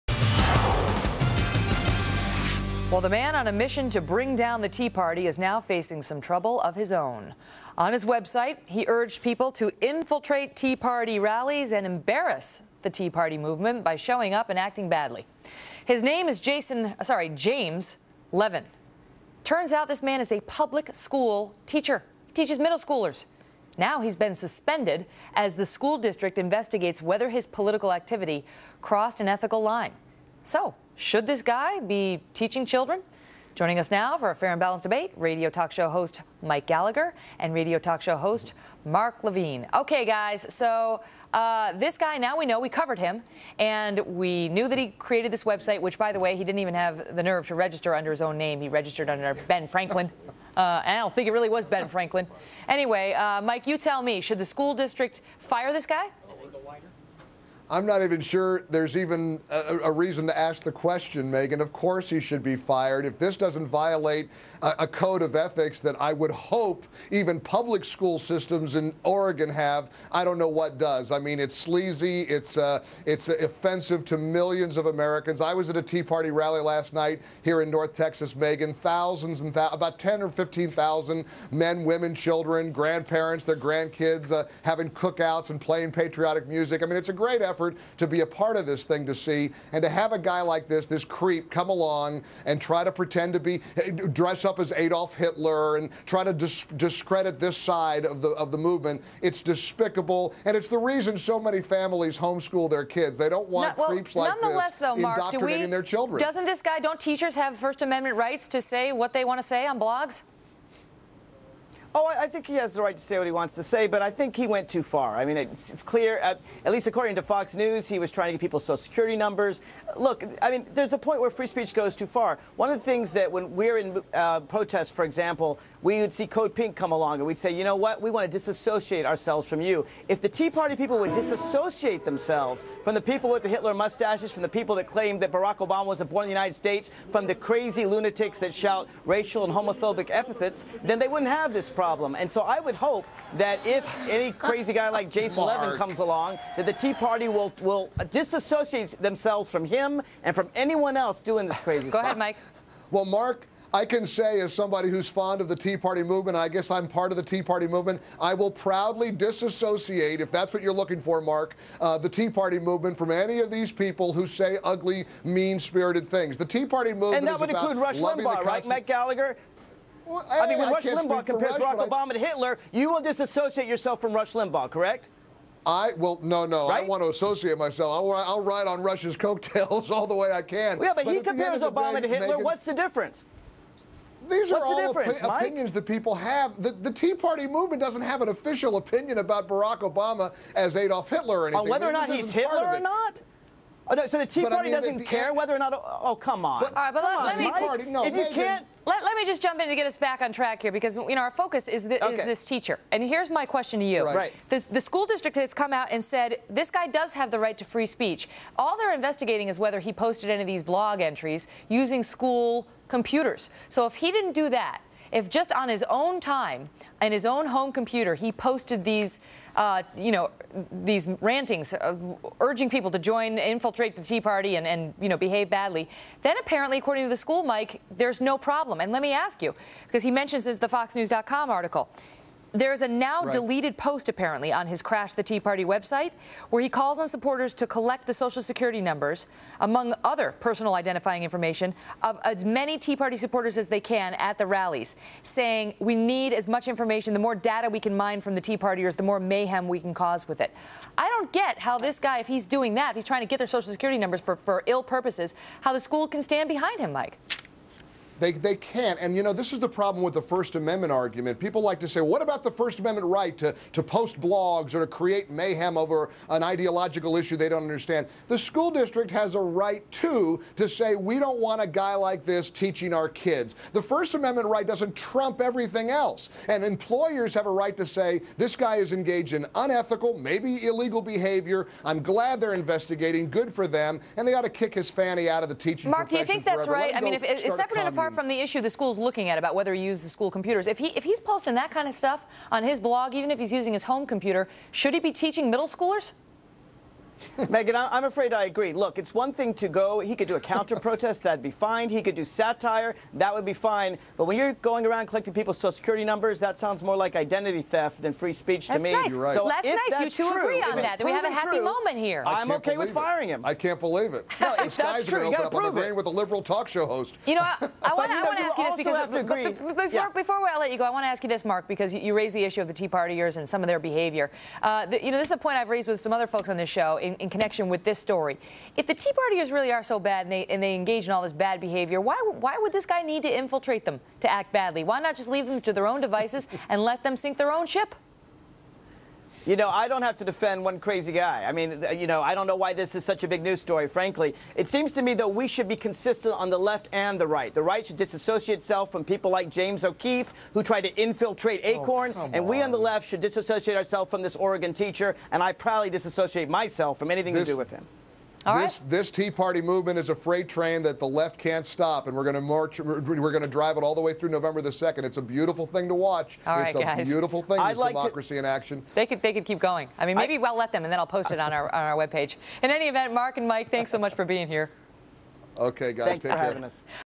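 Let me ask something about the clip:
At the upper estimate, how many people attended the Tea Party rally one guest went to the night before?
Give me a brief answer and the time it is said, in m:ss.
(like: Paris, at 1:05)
15,000, at 1:20.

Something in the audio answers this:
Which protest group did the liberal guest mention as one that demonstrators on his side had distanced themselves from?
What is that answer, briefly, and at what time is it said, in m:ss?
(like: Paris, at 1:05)
Code Pink, at 2:06.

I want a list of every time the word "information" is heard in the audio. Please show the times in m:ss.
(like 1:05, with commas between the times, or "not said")
4:01, 4:06.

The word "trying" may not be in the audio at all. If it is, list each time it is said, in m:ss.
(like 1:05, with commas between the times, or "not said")
1:58, 4:13.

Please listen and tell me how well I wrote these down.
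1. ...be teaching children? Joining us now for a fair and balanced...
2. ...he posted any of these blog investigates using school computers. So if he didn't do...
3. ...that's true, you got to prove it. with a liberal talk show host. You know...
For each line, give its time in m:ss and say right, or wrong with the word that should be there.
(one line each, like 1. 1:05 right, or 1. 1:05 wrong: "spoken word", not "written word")
1. 0:31 right
2. 3:29 wrong: "entries", not "investigates"
3. 5:14 right.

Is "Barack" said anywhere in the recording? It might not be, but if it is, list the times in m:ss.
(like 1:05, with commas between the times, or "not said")
2:15, 2:51, 3:09.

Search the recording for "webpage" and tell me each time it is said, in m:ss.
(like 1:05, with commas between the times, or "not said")
6:11.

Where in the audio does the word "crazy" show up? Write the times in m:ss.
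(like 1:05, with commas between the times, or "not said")
2:17, 2:24, 2:31, 5:40.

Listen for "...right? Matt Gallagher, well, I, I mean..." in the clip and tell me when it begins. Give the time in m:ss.
2:48.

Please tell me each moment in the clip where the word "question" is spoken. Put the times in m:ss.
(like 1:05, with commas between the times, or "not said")
1:00, 3:23.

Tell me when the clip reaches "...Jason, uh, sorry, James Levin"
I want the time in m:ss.
0:16.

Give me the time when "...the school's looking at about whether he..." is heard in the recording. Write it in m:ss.
4:48.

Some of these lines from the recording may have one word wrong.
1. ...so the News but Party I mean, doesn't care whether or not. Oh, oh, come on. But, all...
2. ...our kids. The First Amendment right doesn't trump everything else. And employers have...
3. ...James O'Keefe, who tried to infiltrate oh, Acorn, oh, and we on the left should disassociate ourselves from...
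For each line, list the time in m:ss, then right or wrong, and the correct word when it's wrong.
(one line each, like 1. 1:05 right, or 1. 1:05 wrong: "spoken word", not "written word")
1. 3:14 wrong: "Tea", not "News"
2. 4:32 right
3. 5:49 right.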